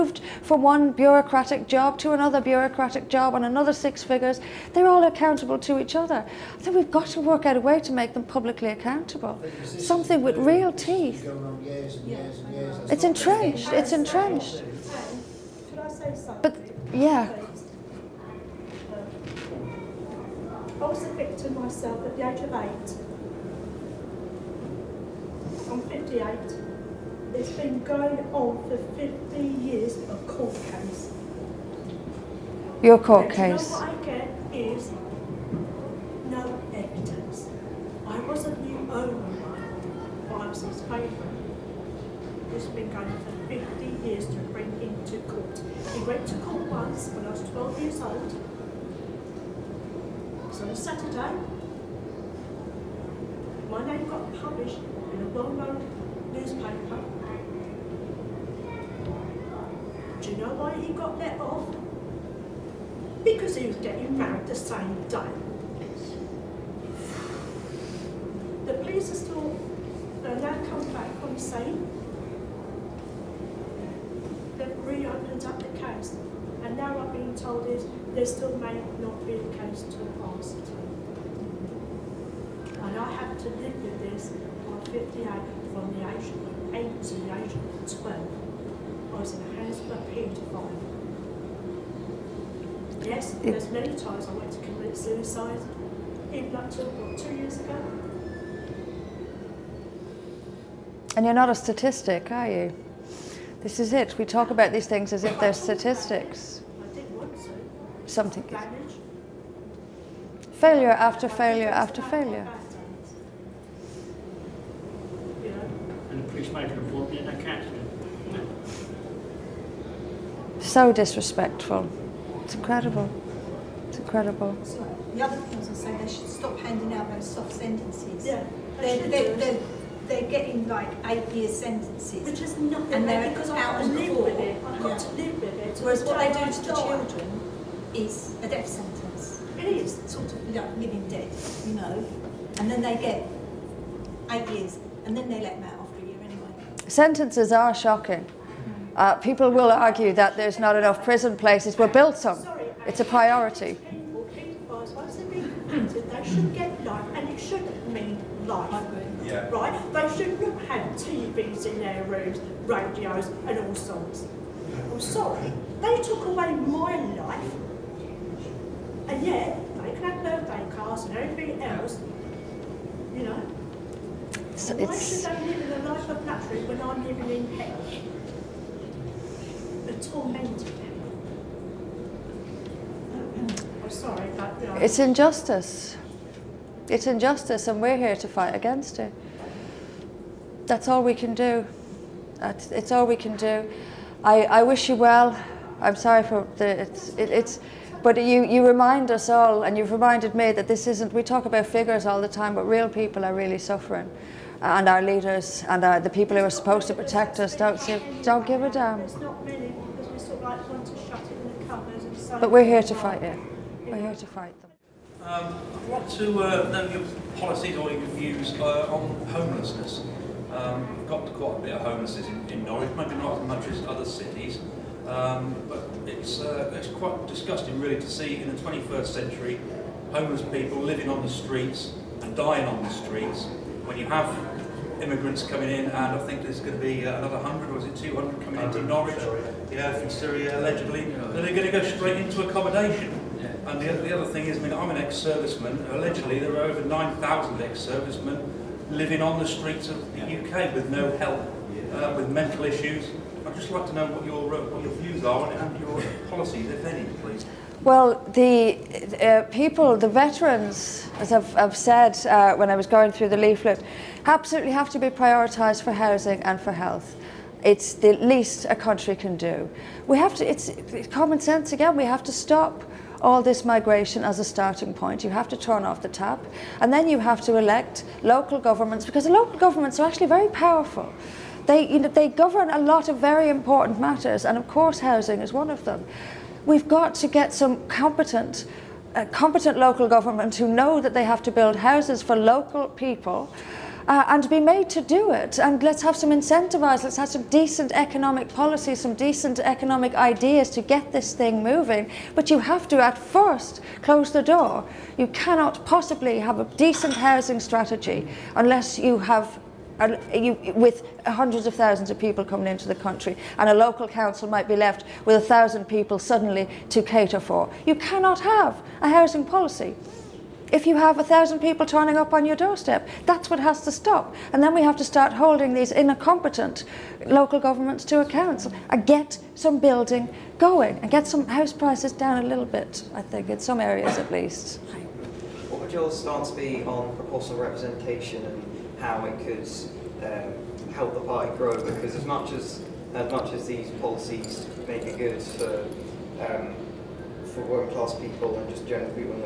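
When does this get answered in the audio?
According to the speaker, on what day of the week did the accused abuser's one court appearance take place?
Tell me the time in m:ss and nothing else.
0:50.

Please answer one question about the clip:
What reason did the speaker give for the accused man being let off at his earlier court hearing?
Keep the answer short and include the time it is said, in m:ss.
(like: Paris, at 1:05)
He was getting married, at 1:03.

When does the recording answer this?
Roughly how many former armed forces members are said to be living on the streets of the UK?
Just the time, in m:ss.
4:06.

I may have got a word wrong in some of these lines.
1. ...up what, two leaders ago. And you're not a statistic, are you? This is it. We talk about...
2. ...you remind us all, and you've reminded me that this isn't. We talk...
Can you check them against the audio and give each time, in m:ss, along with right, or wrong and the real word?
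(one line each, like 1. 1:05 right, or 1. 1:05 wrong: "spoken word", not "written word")
1. 1:36 wrong: "years", not "leaders"
2. 3:18 right.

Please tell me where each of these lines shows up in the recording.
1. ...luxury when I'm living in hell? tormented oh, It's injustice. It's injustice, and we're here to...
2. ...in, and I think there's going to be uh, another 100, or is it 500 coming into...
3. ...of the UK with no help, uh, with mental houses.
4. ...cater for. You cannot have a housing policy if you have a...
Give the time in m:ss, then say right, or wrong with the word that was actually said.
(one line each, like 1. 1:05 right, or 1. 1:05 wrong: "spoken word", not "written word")
1. 2:56 right
2. 3:55 wrong: "200", not "500"
3. 4:09 wrong: "issues", not "houses"
4. 5:17 right.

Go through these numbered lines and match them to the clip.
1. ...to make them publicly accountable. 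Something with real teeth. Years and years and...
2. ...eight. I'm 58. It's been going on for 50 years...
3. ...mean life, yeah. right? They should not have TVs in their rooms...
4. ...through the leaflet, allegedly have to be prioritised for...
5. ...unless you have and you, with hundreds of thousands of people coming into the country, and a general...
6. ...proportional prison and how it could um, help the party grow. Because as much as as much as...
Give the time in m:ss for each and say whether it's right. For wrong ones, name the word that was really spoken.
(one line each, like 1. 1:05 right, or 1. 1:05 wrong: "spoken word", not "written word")
1. 0:07 right
2. 0:22 right
3. 2:37 right
4. 4:23 wrong: "absolutely", not "allegedly"
5. 5:08 wrong: "local", not "general"
6. 5:37 wrong: "representation", not "prison".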